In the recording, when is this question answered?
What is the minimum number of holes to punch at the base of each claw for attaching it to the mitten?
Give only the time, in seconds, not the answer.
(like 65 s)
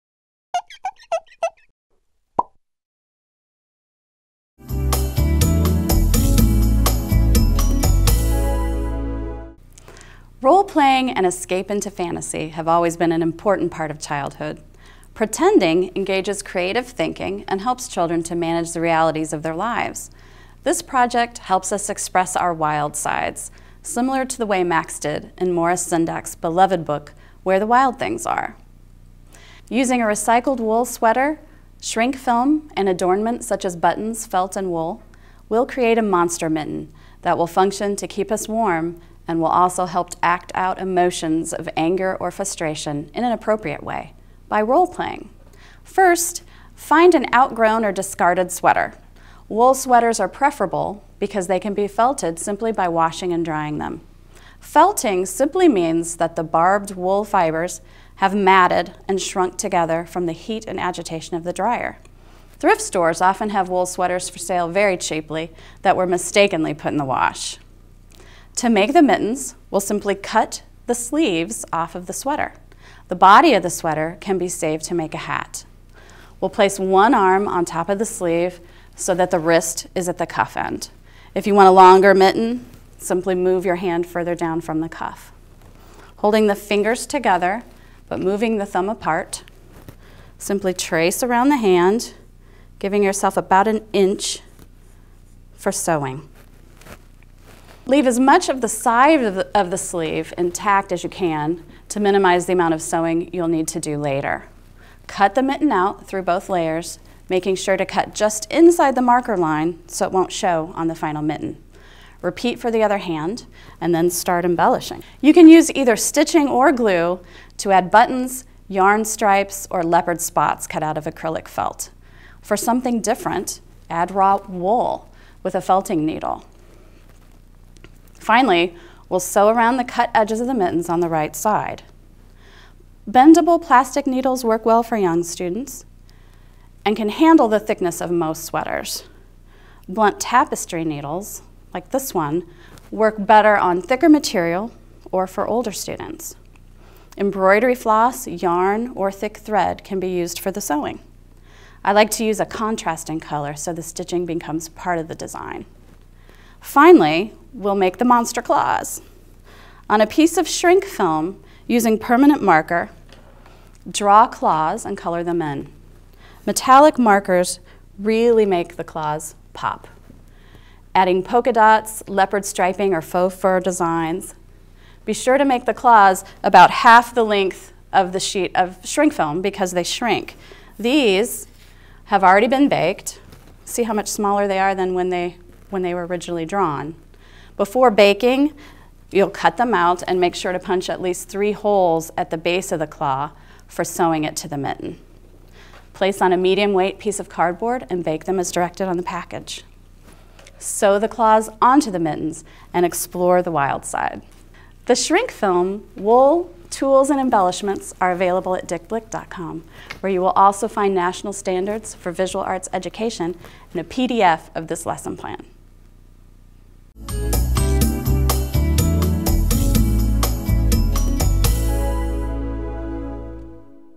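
191 s.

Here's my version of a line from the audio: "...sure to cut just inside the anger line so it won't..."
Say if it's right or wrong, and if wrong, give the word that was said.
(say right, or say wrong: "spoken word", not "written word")
wrong: "marker", not "anger".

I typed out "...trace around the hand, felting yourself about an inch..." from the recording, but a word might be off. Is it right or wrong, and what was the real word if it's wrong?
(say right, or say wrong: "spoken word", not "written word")
wrong: "giving", not "felting".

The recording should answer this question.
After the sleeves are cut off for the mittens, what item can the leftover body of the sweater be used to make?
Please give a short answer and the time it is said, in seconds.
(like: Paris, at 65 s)
a hat, at 75 s.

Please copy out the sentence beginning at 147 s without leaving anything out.
Embroidery floss, yarn, or thick thread can be used for the sewing.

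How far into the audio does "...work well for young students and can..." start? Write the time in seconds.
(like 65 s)
134 s.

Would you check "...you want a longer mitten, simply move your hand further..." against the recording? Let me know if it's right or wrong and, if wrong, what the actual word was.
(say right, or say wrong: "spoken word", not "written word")
right.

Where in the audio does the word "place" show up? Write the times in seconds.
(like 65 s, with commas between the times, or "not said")
76 s, 195 s.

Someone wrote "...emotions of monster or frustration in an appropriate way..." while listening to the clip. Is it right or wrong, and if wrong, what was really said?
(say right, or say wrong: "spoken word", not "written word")
wrong: "anger", not "monster".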